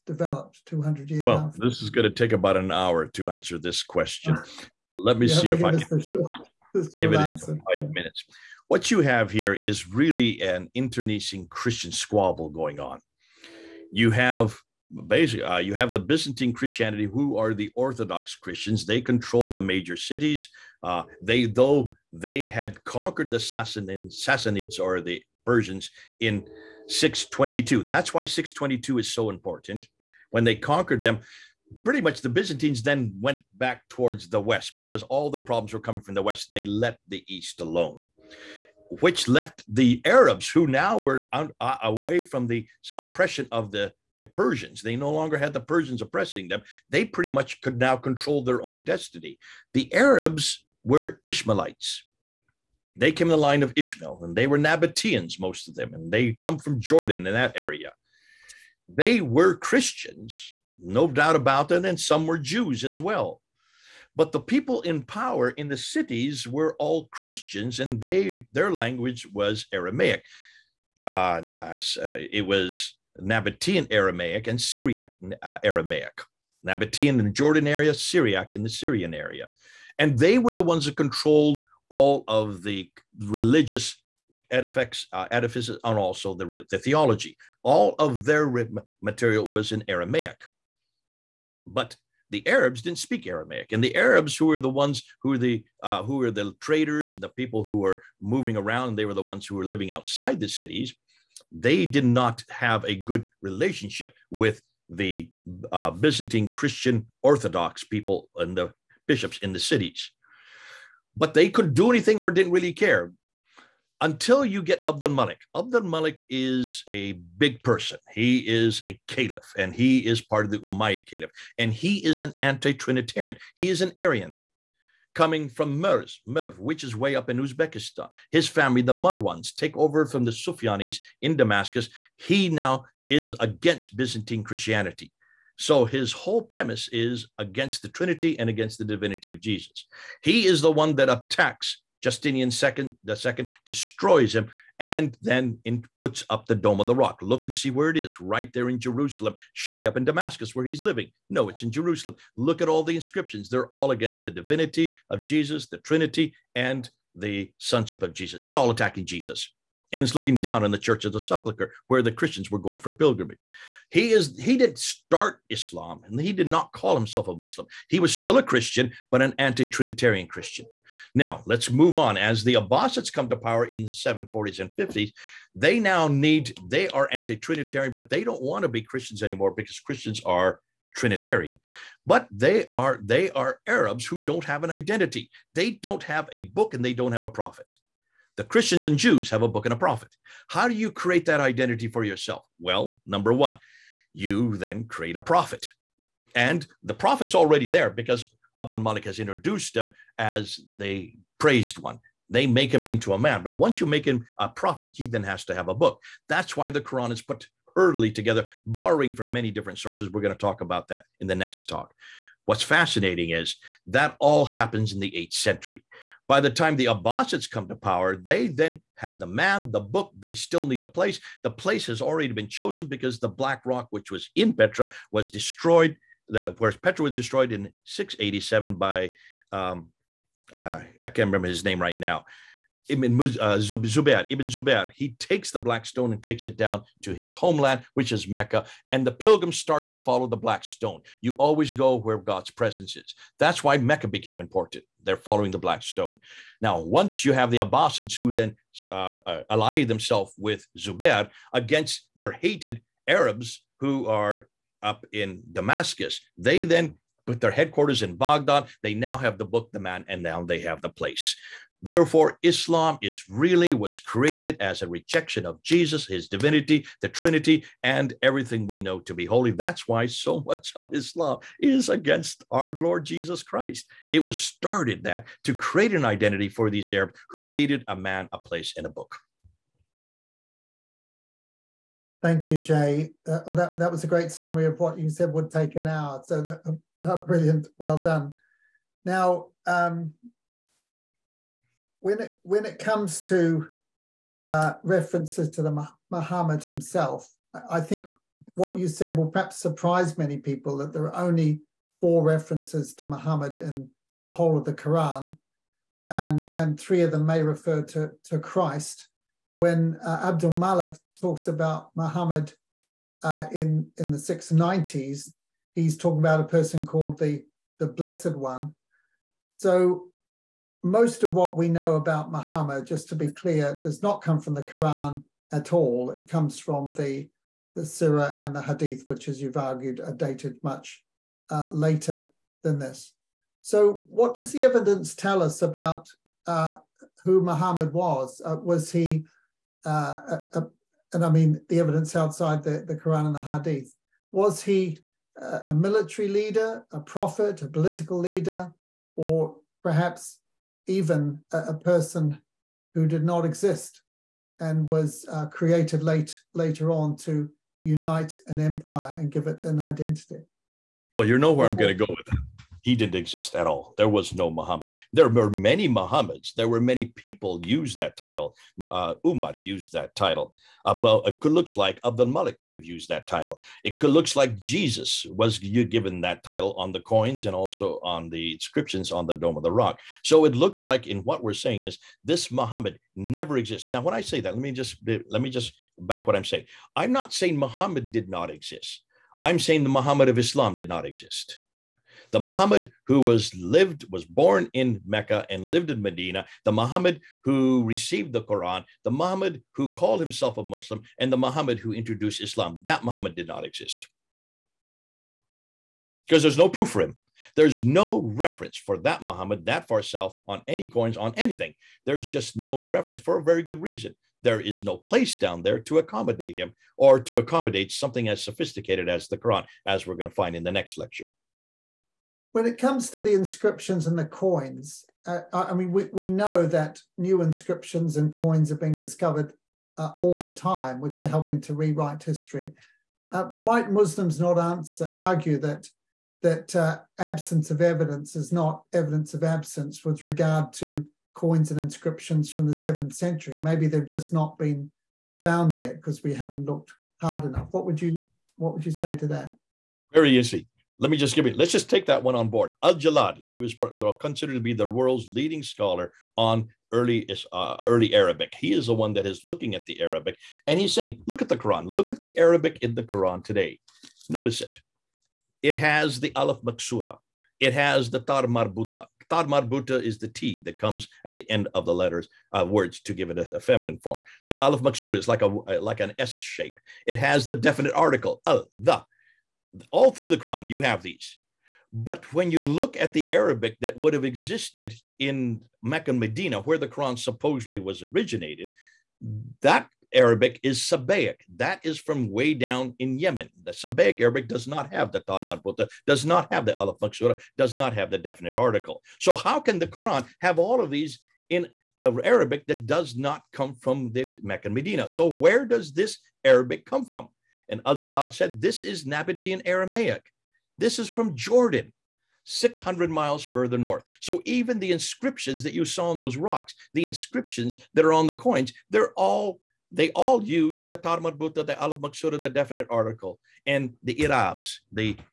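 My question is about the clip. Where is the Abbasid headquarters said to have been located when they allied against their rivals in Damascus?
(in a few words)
Baghdad.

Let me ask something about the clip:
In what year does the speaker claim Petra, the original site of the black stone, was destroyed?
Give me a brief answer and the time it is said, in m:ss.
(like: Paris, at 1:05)
687, at 3:47.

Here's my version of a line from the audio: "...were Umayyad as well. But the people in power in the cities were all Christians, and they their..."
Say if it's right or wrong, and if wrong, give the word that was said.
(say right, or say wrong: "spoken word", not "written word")
wrong: "Jews", not "Umayyad".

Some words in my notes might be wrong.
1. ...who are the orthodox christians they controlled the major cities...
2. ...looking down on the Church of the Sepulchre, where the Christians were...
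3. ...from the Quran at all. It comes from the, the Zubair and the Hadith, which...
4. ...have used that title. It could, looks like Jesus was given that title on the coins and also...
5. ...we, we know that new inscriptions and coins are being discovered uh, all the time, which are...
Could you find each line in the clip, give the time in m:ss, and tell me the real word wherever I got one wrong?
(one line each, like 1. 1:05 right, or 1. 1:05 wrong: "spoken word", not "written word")
1. 0:17 right
2. 2:40 right
3. 5:24 wrong: "Sira", not "Zubair"
4. 6:12 right
5. 7:05 right.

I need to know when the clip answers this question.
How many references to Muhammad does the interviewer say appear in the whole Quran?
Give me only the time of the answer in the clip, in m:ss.
5:02.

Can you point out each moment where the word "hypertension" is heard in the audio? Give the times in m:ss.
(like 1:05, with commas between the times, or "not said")
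not said.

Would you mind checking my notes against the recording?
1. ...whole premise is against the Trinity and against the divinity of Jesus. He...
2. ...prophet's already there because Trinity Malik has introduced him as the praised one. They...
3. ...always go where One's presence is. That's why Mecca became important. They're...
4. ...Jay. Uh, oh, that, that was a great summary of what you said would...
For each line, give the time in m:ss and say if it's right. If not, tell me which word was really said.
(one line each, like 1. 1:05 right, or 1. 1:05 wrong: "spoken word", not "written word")
1. 2:16 right
2. 3:16 wrong: "Abdul", not "Trinity"
3. 4:01 wrong: "God", not "One"
4. 4:42 right.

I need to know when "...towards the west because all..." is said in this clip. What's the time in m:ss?
0:33.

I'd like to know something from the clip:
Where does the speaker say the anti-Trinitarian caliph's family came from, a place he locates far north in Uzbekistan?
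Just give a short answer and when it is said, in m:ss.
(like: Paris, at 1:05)
Merv, at 2:06.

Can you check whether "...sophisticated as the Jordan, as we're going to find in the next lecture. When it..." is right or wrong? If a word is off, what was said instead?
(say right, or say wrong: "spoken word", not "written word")
wrong: "Quran", not "Jordan".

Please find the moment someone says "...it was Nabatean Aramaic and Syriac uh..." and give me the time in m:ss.
1:12.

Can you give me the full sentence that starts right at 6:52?
There's just no reference for a very good reason.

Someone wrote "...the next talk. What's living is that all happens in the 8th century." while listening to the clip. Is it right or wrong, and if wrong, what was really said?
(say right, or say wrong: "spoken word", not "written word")
wrong: "fascinating", not "living".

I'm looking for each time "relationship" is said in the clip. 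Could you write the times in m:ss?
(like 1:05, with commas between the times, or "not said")
1:43.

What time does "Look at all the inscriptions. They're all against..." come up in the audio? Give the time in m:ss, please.
2:32.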